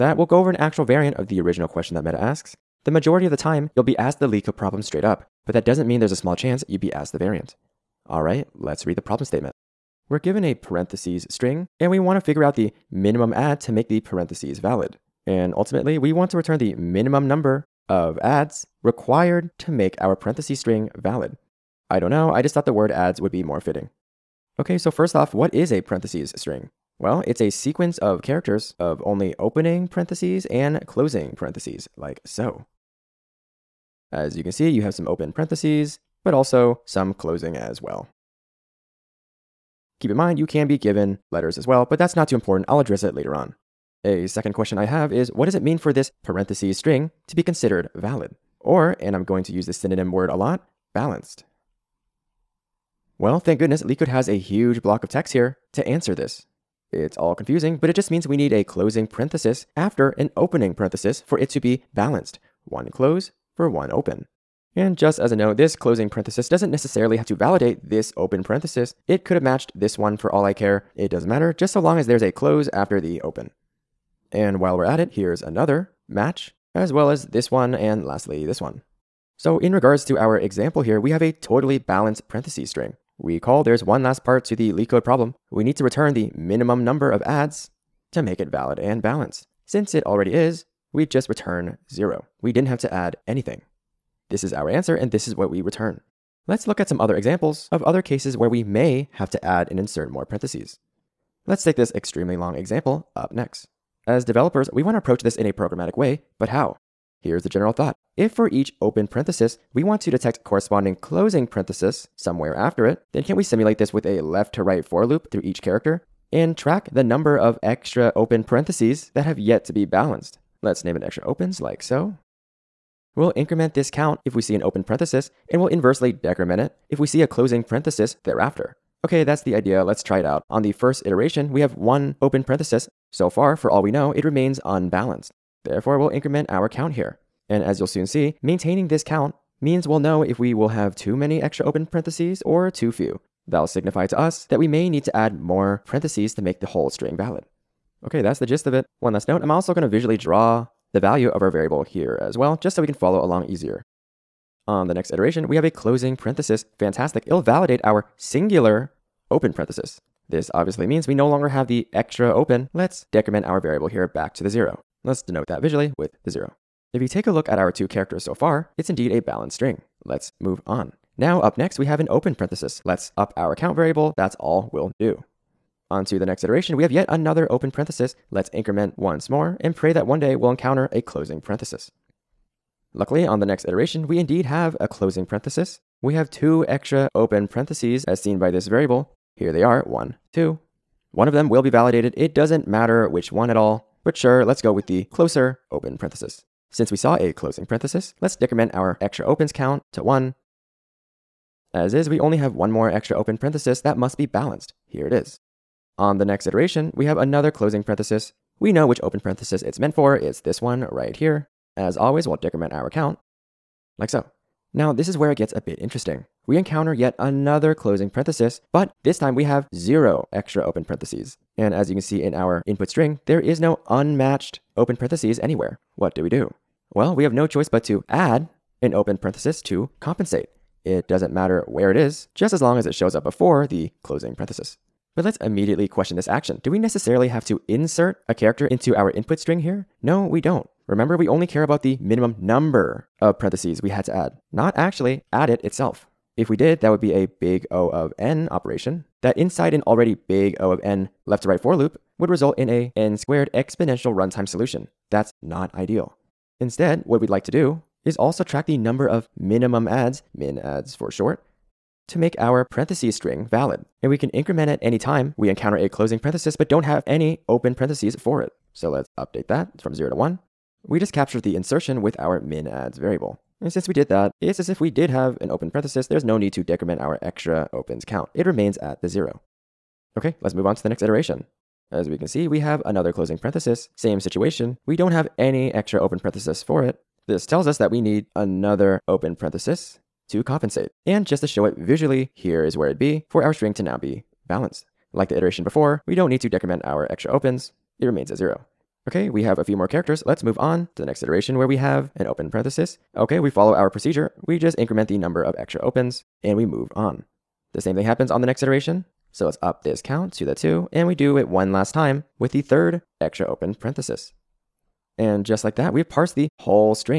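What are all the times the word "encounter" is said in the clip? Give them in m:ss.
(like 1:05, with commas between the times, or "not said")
3:00, 3:36, 4:25.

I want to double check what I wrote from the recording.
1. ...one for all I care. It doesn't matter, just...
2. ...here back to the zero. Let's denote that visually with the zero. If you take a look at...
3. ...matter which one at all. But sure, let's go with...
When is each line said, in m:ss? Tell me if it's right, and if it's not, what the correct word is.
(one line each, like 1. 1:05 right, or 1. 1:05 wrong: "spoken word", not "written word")
1. 1:09 right
2. 2:43 right
3. 3:12 right.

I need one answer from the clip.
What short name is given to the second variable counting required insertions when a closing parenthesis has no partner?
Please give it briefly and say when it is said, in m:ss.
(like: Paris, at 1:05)
min adds, at 4:20.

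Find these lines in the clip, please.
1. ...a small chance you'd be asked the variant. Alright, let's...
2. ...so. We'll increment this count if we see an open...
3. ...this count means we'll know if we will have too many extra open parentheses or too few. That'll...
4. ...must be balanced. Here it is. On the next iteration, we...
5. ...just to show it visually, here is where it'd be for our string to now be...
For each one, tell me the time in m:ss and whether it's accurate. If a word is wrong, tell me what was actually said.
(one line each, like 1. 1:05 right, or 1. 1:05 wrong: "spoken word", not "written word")
1. 0:06 right
2. 2:01 right
3. 2:18 right
4. 3:23 right
5. 4:51 right.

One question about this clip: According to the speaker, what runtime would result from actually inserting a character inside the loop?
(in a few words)
n squared.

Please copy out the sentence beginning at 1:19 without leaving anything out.
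So in regards to our example here, we have a totally balanced parentheses string.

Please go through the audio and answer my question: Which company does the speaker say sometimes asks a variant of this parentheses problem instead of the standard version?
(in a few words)
Meta.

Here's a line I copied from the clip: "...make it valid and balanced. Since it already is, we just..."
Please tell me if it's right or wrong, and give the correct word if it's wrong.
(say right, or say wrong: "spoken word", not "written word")
right.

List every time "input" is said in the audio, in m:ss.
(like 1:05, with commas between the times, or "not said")
3:42, 3:59.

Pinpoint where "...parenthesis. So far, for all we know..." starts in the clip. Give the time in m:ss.
2:12.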